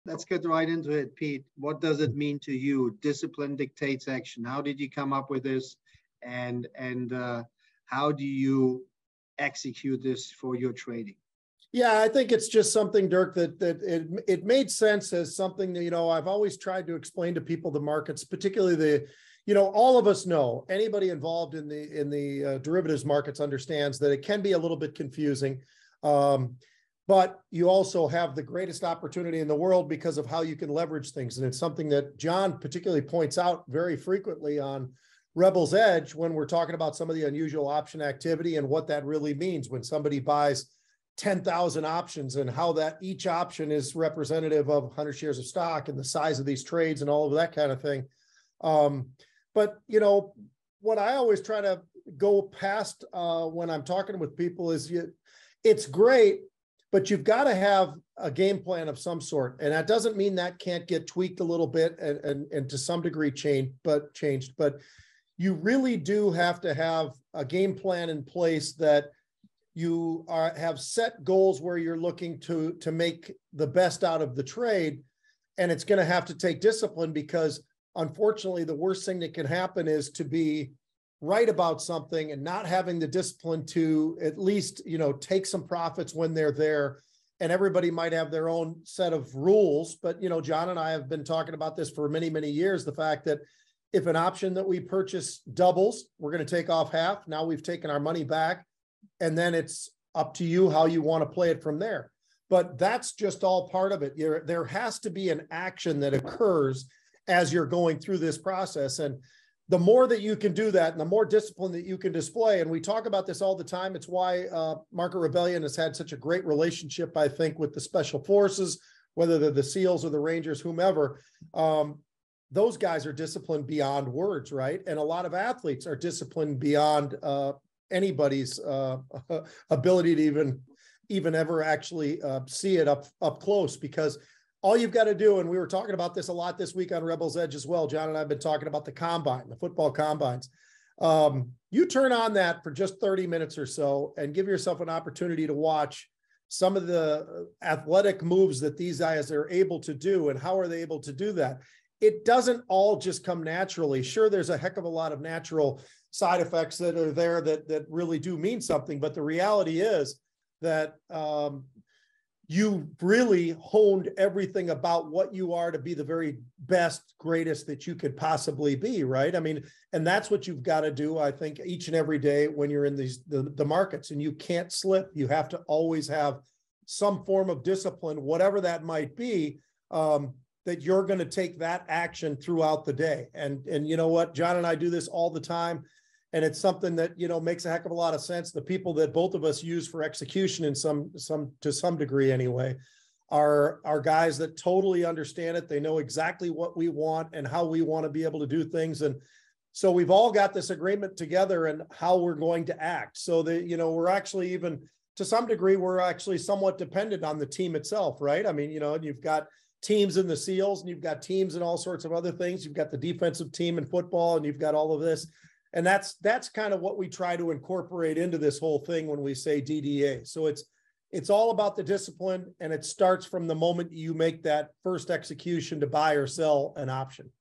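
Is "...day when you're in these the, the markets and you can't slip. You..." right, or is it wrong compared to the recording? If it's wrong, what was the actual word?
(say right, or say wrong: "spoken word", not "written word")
right.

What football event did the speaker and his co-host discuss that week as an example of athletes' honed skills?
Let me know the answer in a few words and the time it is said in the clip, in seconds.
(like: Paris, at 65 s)
the combine, at 138 s.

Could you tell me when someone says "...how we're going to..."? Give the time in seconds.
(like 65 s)
201 s.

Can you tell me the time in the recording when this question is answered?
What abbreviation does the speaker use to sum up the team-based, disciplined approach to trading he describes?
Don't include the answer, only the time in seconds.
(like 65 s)
219 s.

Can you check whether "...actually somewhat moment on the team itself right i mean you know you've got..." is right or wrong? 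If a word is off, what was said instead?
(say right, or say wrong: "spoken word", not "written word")
wrong: "dependent", not "moment".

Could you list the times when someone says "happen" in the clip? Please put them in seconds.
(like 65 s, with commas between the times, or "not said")
79 s.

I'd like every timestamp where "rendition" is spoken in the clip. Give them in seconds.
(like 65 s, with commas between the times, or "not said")
not said.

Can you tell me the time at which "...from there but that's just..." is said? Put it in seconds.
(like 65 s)
101 s.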